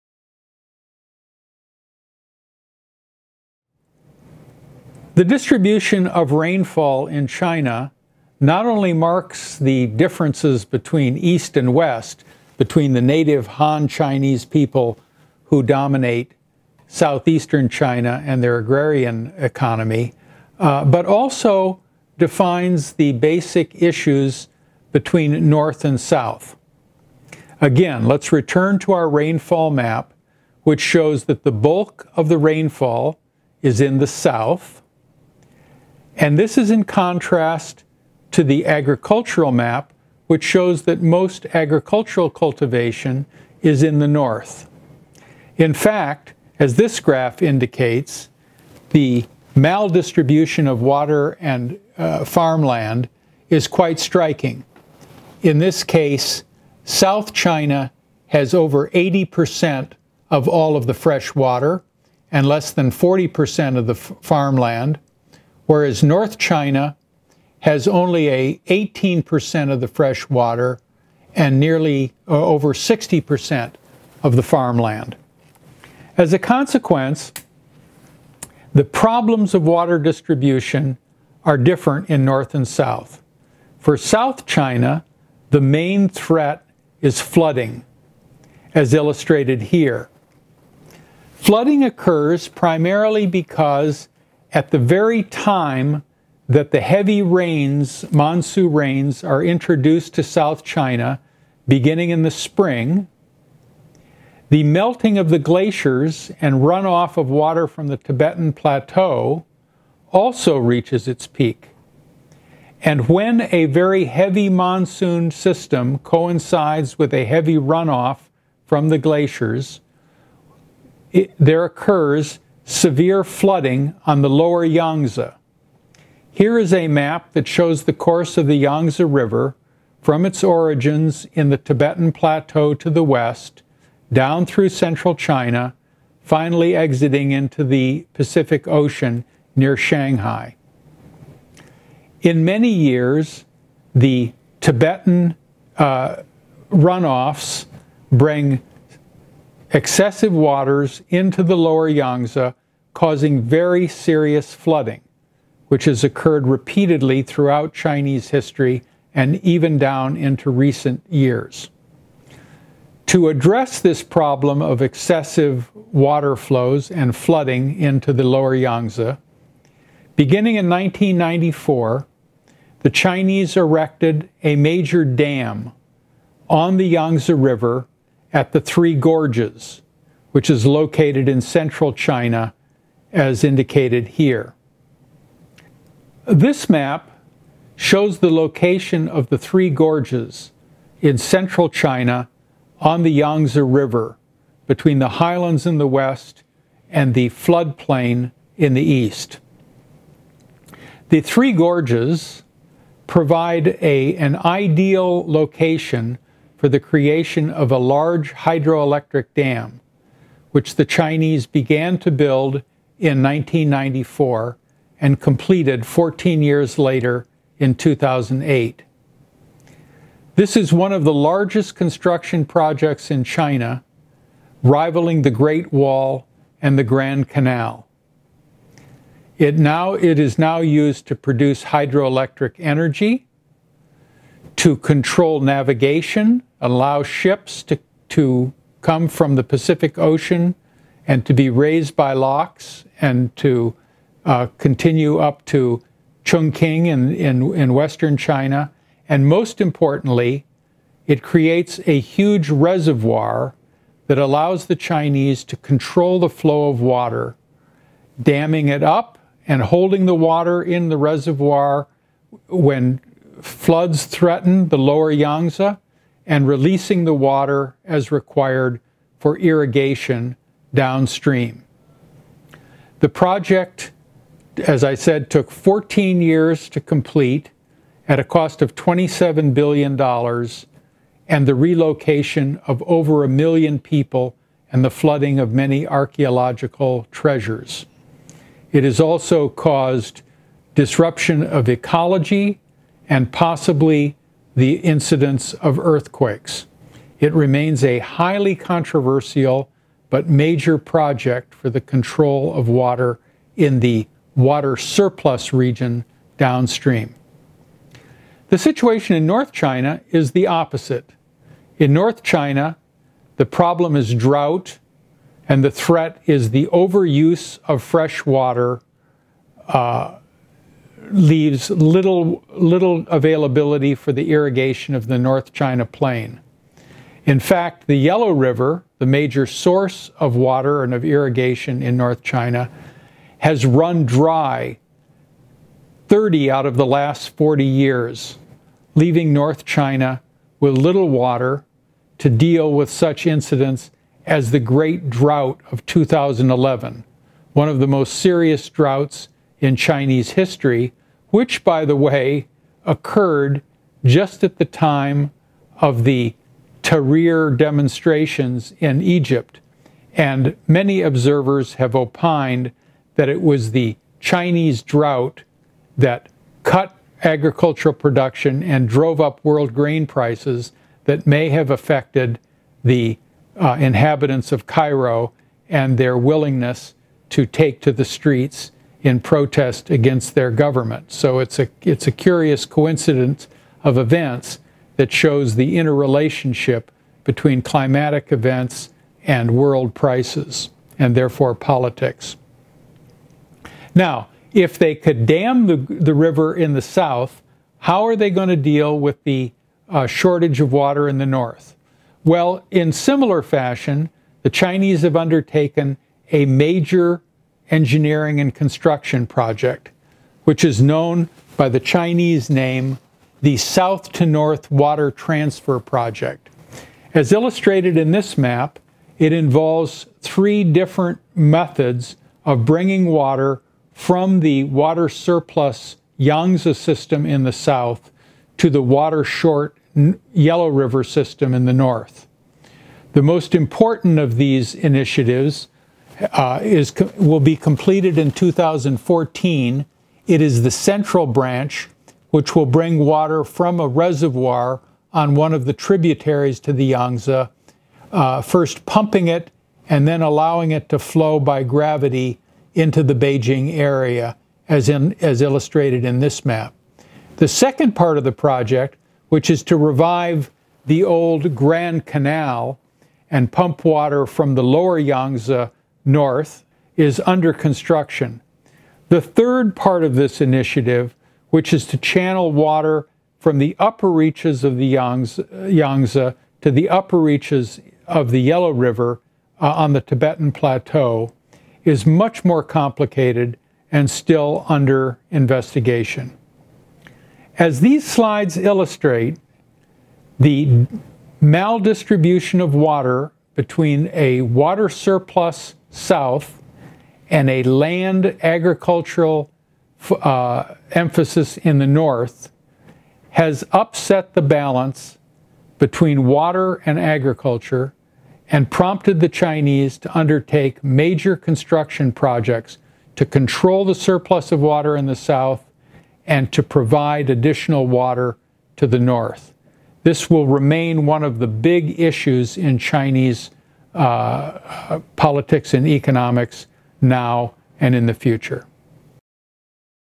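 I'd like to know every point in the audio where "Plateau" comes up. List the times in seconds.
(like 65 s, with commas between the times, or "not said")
108 s, 132 s, 480 s.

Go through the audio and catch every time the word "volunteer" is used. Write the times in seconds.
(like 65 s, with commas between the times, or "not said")
not said.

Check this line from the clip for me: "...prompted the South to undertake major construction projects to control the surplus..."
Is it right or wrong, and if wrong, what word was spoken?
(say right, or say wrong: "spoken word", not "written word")
wrong: "Chinese", not "South".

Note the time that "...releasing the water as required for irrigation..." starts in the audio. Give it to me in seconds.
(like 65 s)
266 s.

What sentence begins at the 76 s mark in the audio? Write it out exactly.
As a consequence, the problems of water distribution are different in North and South.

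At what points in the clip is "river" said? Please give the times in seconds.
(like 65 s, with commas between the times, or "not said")
129 s, 177 s, 193 s, 328 s, 396 s, 430 s, 478 s.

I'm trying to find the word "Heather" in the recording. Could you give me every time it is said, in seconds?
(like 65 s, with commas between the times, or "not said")
not said.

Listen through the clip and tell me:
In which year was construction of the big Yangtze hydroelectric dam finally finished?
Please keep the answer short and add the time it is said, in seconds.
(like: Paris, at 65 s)
2008, at 217 s.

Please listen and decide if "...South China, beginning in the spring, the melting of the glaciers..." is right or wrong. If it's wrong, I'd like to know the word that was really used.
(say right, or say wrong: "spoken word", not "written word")
right.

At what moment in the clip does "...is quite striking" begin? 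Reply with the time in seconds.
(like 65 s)
53 s.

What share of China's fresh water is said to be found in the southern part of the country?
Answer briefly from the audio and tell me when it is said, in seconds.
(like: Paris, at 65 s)
over 80%, at 58 s.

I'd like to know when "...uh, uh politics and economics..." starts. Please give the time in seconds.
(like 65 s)
523 s.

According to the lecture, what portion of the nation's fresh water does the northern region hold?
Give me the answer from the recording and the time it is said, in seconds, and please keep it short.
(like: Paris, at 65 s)
18%, at 68 s.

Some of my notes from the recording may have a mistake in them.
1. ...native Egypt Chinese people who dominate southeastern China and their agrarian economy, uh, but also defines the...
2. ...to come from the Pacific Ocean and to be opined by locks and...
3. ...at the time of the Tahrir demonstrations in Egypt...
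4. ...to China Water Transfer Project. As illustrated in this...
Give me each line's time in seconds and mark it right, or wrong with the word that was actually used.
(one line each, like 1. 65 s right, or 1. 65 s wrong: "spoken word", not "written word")
1. 13 s wrong: "Han", not "Egypt"
2. 238 s wrong: "raised", not "opined"
3. 354 s right
4. 414 s wrong: "North", not "China".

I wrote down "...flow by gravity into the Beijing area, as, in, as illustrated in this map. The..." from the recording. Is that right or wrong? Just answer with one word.
right.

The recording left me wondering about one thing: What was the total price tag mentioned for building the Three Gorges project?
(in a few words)
$27 billion.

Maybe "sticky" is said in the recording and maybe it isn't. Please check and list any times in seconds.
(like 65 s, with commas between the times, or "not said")
not said.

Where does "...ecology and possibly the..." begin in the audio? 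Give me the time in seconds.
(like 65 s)
291 s.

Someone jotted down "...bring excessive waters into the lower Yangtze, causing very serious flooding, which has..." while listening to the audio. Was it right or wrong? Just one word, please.
right.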